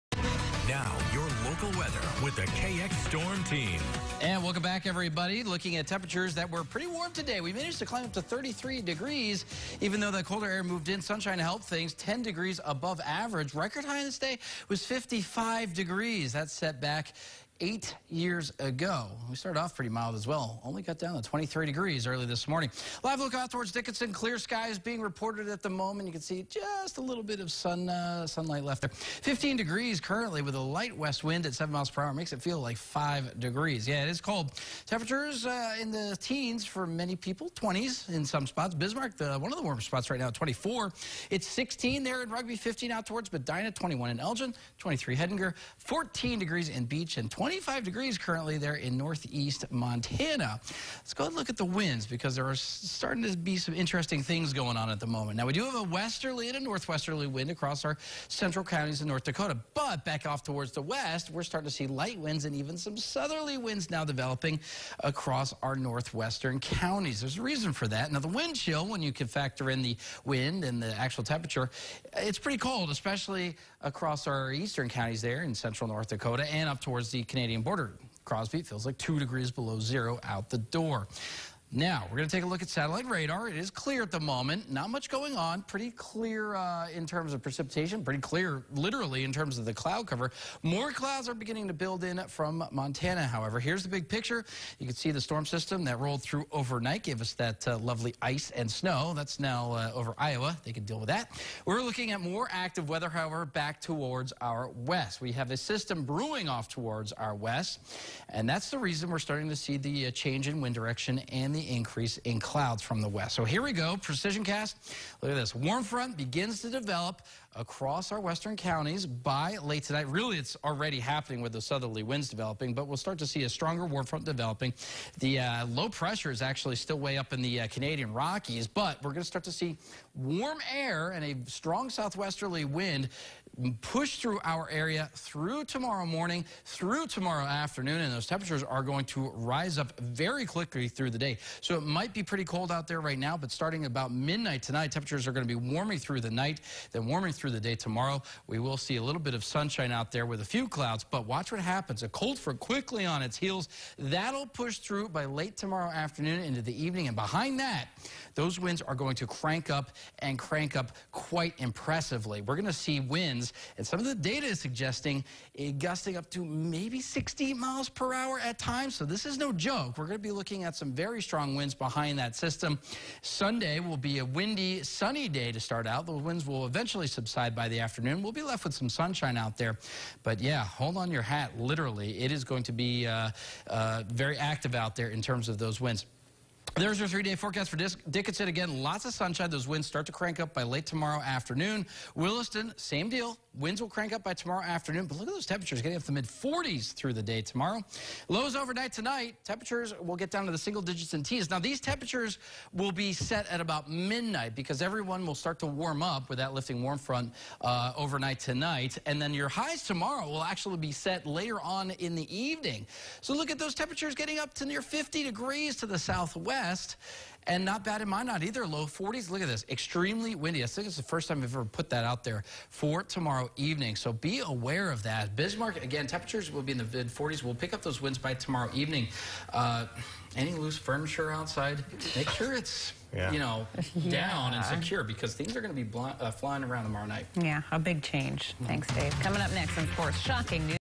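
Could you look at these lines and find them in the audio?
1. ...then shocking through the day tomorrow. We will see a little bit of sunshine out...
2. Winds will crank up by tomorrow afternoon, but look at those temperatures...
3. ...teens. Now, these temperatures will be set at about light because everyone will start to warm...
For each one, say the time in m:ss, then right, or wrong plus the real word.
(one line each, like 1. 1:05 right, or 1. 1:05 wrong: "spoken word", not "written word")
1. 2:26 wrong: "warming", not "shocking"
2. 3:13 right
3. 3:21 wrong: "midnight", not "light".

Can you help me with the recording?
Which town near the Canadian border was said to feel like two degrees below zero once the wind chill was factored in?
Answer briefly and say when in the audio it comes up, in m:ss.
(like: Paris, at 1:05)
Crosby, at 1:18.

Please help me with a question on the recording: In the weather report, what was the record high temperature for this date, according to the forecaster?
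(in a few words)
55 degrees.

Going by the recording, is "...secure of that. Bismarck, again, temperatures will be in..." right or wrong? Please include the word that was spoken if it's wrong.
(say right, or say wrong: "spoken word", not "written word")
wrong: "aware", not "secure".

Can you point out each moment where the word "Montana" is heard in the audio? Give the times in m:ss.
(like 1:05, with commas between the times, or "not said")
0:49, 1:32.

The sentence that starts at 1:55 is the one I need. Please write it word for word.
Warm front begins to develop across our western counties by late tonight.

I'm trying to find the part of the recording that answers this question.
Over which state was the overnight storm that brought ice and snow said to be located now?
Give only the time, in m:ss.
1:40.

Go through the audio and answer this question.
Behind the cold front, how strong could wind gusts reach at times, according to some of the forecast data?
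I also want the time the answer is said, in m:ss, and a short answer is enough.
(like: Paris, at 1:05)
60 mph, at 2:47.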